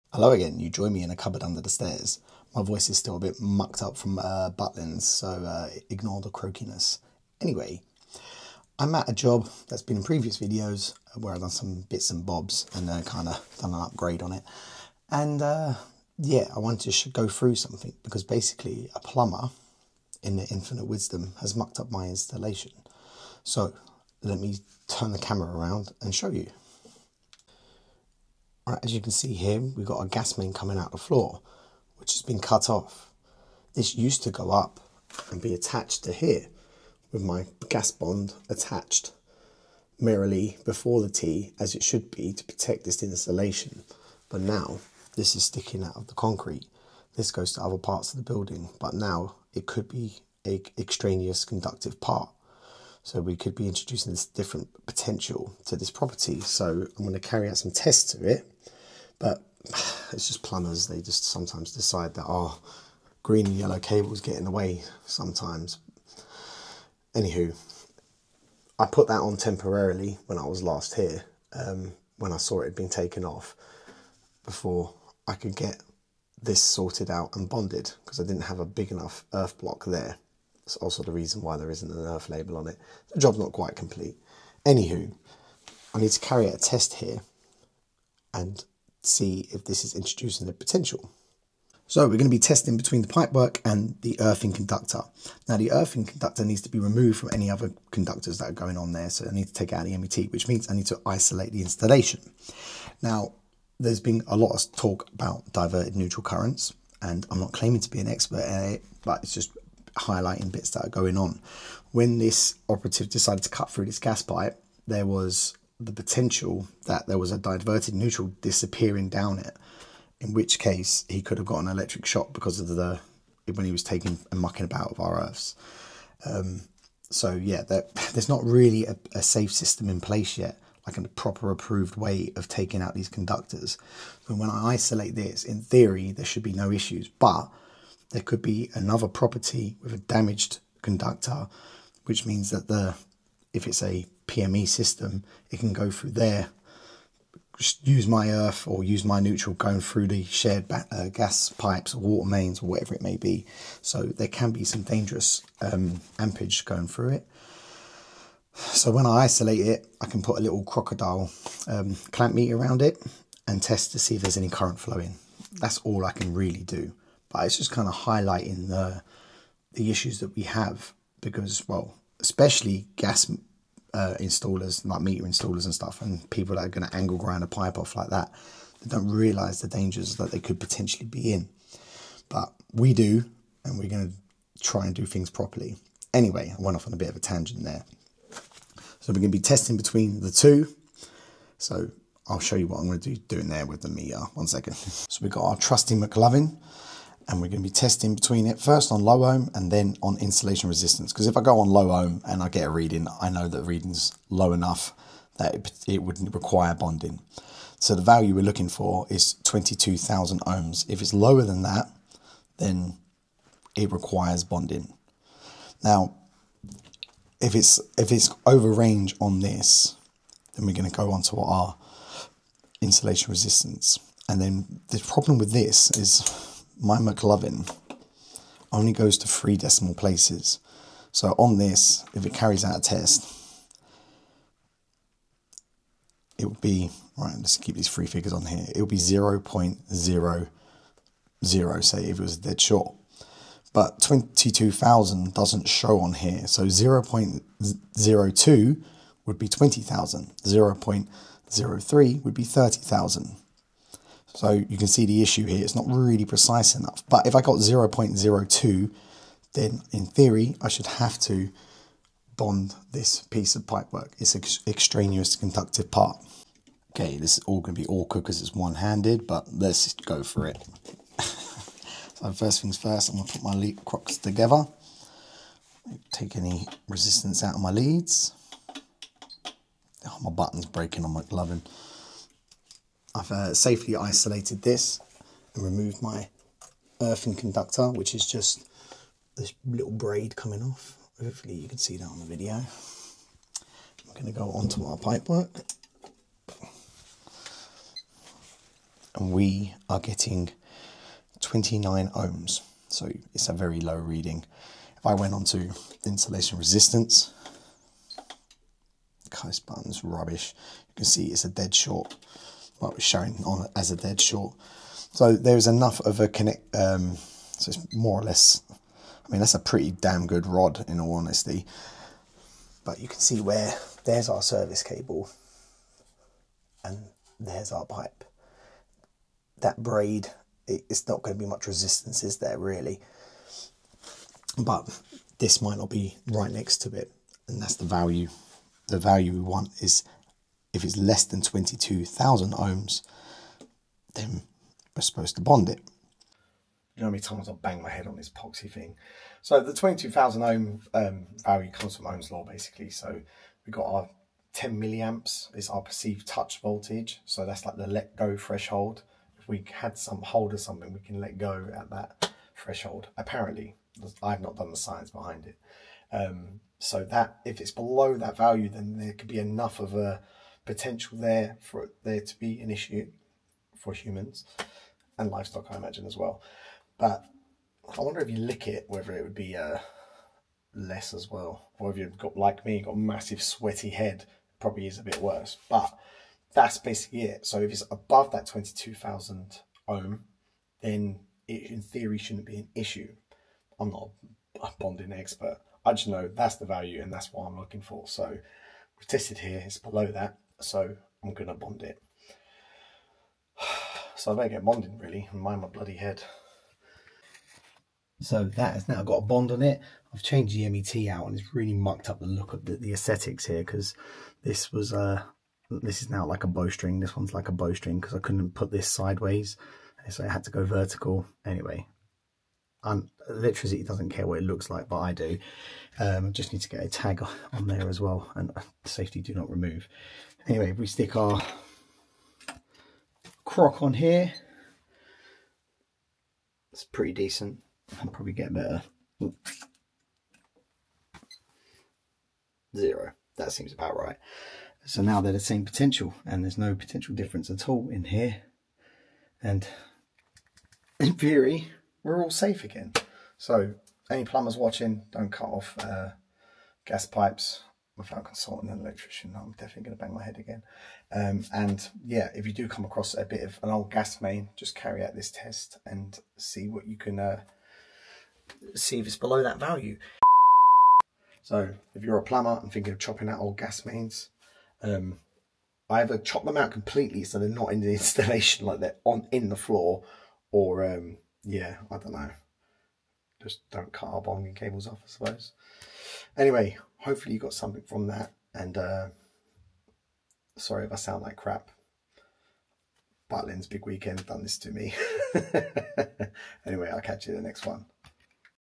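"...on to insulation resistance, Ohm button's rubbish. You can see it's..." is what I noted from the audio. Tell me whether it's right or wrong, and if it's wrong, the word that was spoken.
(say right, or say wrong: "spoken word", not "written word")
wrong: "Kais", not "Ohm".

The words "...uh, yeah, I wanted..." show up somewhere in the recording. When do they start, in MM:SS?
00:15.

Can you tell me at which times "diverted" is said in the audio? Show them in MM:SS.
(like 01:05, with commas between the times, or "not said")
01:45, 01:57.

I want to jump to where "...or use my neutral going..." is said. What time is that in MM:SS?
02:28.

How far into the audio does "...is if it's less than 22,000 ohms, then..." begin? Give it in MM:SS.
05:39.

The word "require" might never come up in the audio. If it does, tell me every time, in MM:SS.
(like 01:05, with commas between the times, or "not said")
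03:26, 03:33.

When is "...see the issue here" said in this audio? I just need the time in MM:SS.
04:14.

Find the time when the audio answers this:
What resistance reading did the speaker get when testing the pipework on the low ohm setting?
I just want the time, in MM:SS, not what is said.
05:01.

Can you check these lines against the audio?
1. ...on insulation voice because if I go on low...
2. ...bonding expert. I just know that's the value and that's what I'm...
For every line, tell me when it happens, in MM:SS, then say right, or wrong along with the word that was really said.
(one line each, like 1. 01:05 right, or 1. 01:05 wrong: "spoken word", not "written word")
1. 03:20 wrong: "resistance", not "voice"
2. 06:34 right.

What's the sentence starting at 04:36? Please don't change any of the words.
Take any resistance out of my leads.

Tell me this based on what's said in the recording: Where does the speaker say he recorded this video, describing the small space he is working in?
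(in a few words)
Cupboard under the stairs.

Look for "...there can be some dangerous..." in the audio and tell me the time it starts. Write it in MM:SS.
02:34.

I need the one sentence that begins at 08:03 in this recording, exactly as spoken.
Just don't cut our bonding cables off, I suppose.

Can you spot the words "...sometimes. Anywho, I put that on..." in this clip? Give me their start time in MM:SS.
01:05.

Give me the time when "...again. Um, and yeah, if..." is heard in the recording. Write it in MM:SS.
07:40.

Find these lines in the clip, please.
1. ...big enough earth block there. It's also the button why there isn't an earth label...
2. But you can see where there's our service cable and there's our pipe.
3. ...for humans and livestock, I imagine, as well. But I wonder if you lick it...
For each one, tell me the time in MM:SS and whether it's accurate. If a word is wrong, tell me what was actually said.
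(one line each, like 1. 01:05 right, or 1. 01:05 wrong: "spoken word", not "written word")
1. 01:18 wrong: "reason", not "button"
2. 05:22 right
3. 06:13 right.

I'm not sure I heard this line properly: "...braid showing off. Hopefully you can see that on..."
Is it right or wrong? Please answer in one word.
wrong.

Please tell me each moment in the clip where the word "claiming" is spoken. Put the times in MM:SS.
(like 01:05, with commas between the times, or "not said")
01:47.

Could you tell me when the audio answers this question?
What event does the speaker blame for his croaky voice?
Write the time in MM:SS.
00:04.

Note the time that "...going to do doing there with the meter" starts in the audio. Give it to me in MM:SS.
03:12.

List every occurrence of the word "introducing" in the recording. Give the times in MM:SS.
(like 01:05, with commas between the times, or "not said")
00:53, 01:29.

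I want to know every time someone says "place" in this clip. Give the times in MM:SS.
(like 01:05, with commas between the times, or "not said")
02:09, 03:49.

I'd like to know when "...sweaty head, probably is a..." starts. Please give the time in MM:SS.
06:23.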